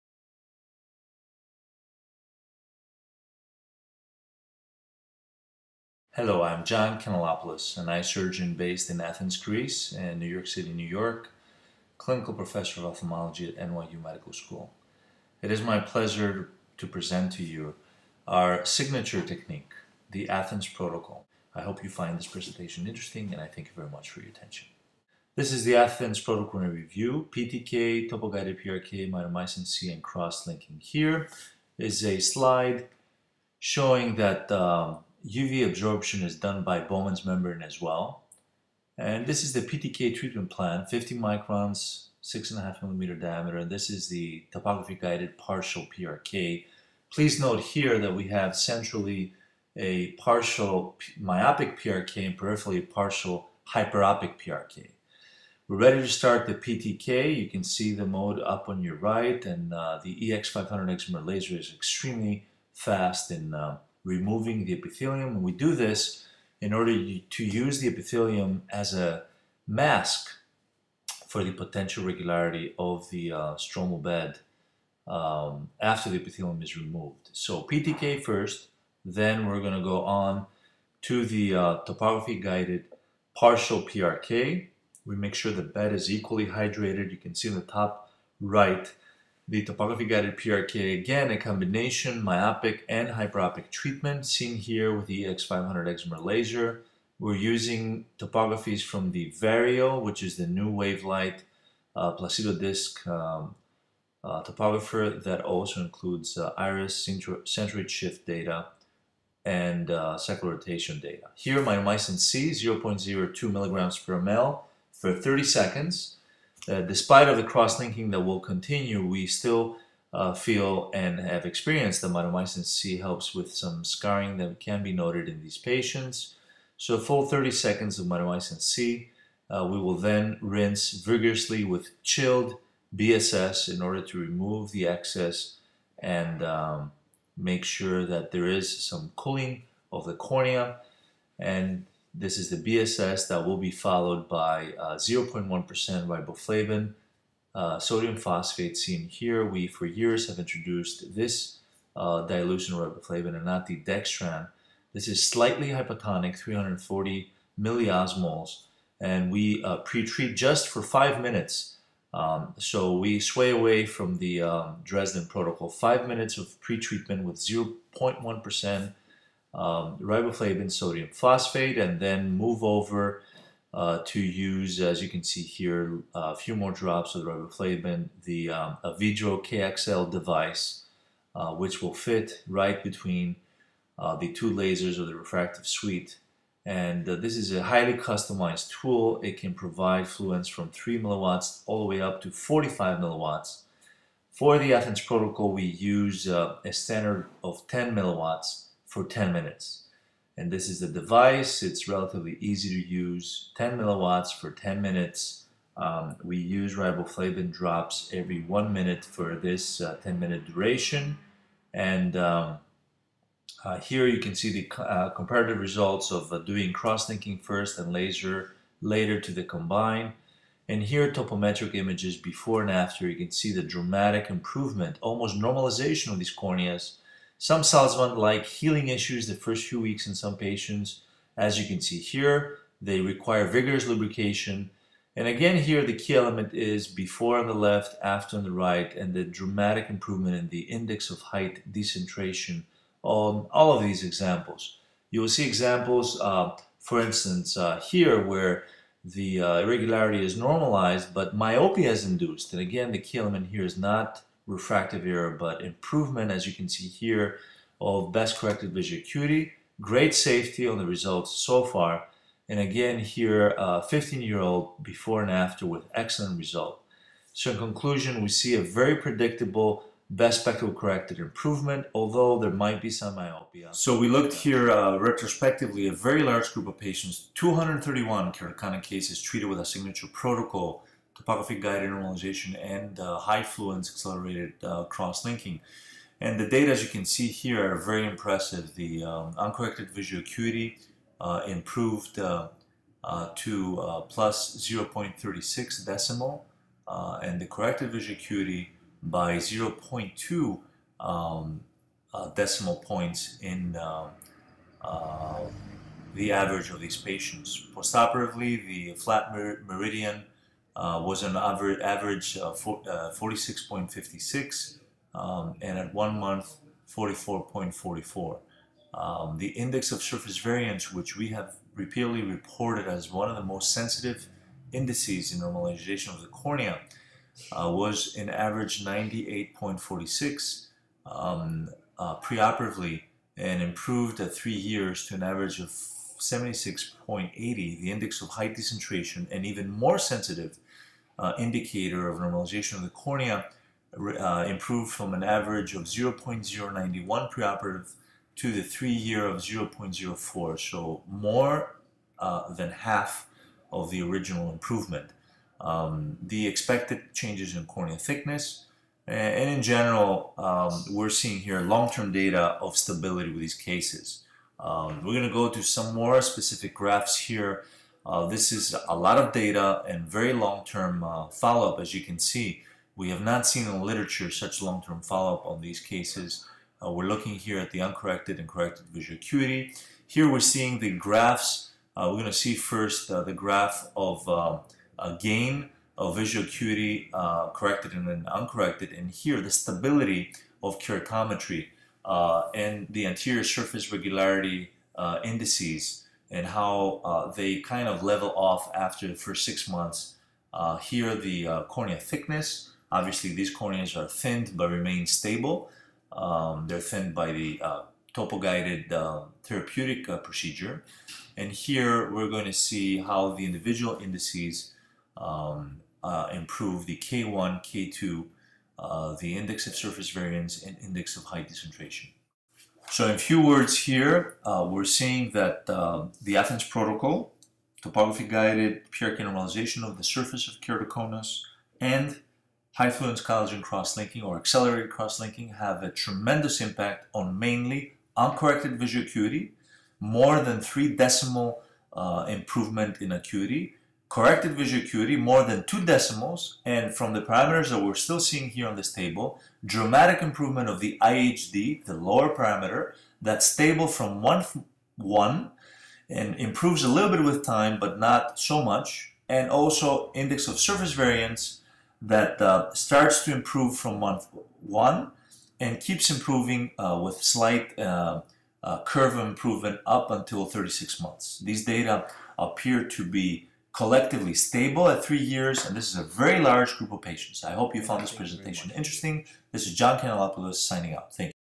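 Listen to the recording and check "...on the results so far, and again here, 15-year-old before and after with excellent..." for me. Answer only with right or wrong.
right.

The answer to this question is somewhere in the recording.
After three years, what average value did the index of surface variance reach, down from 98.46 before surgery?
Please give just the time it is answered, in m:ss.
5:36.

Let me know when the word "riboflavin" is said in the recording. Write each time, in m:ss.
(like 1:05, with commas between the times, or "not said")
2:26, 2:32, 2:49, 2:57, 3:26.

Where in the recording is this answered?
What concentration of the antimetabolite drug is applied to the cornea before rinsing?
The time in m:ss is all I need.
1:52.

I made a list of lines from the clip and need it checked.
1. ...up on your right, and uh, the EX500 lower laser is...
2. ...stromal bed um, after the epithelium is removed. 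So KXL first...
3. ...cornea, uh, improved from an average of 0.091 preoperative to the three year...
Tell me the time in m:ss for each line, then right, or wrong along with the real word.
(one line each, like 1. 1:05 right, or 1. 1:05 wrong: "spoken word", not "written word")
1. 0:58 wrong: "excimer", not "lower"
2. 1:13 wrong: "PTK", not "KXL"
3. 5:42 right.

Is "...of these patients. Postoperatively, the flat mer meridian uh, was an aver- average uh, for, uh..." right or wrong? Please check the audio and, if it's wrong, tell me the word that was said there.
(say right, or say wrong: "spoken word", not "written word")
right.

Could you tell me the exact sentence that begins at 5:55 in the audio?
Um, the expected changes in cornea thickness, and in general, um, we're seeing here long-term data of stability with these cases.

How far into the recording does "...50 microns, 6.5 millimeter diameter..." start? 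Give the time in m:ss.
0:40.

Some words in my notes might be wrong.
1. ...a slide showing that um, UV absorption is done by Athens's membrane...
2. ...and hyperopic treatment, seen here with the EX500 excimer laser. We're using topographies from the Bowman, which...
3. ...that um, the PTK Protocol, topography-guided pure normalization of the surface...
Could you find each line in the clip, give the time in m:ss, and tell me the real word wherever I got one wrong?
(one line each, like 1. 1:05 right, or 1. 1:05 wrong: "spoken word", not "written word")
1. 0:32 wrong: "Bowman", not "Athens"
2. 1:32 wrong: "Vario", not "Bowman"
3. 7:05 wrong: "Athens", not "PTK".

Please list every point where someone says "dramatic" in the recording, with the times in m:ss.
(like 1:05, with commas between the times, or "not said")
3:43, 3:59, 7:29.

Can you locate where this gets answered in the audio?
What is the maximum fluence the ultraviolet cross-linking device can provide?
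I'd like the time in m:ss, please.
3:12.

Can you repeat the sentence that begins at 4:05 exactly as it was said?
You will see examples, uh, for instance, uh, here where the uh, irregularity is normalized, but myopia is induced.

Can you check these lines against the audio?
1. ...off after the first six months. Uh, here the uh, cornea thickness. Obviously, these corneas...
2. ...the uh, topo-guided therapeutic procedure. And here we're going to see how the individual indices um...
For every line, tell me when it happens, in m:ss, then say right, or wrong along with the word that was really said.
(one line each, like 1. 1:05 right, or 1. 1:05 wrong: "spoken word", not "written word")
1. 6:38 right
2. 6:47 right.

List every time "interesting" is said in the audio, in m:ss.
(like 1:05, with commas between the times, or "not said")
0:22, 7:58.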